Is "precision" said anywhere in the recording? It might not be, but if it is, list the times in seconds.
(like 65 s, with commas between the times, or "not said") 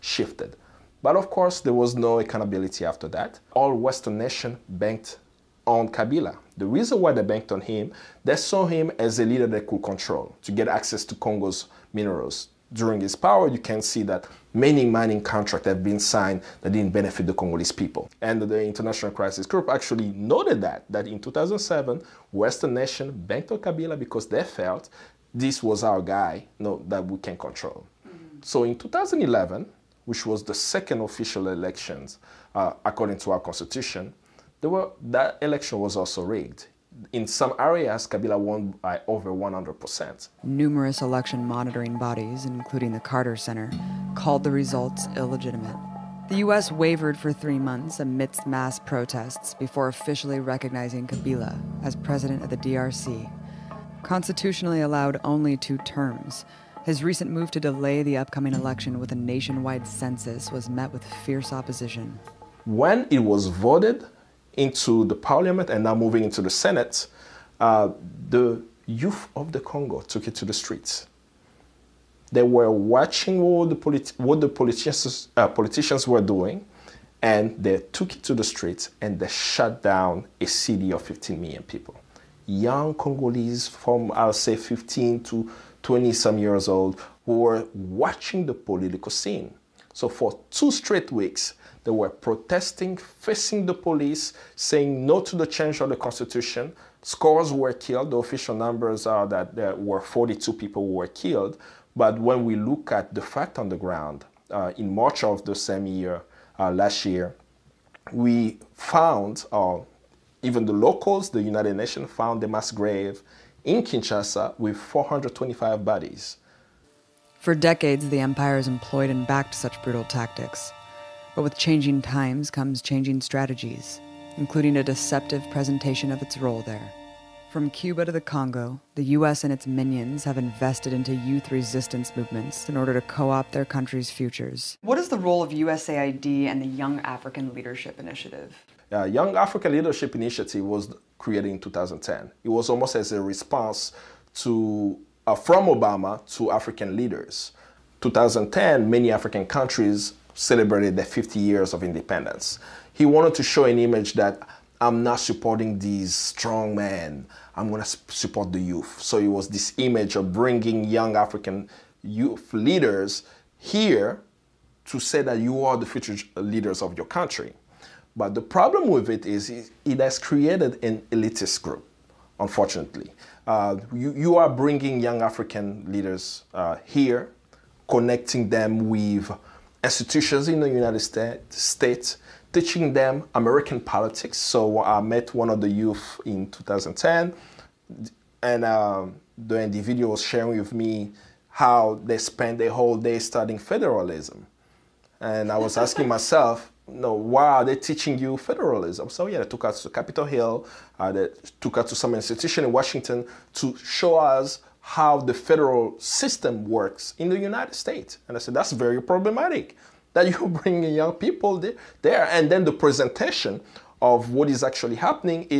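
not said.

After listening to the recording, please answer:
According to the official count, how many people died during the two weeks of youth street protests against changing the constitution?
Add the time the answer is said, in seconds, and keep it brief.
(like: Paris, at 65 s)
42, at 99 s.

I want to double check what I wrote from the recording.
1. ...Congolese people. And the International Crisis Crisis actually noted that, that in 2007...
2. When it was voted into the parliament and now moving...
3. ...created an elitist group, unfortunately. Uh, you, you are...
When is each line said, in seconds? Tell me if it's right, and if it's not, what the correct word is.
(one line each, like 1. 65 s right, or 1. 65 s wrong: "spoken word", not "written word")
1. 17 s wrong: "Group", not "Crisis"
2. 62 s right
3. 170 s right.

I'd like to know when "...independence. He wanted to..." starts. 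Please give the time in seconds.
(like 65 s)
151 s.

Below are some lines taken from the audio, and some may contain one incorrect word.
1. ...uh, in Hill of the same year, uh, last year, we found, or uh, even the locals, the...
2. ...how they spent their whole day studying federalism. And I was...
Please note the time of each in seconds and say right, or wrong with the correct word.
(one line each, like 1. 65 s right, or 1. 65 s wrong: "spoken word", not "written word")
1. 104 s wrong: "March", not "Hill"
2. 191 s right.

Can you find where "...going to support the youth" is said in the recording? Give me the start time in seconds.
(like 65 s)
157 s.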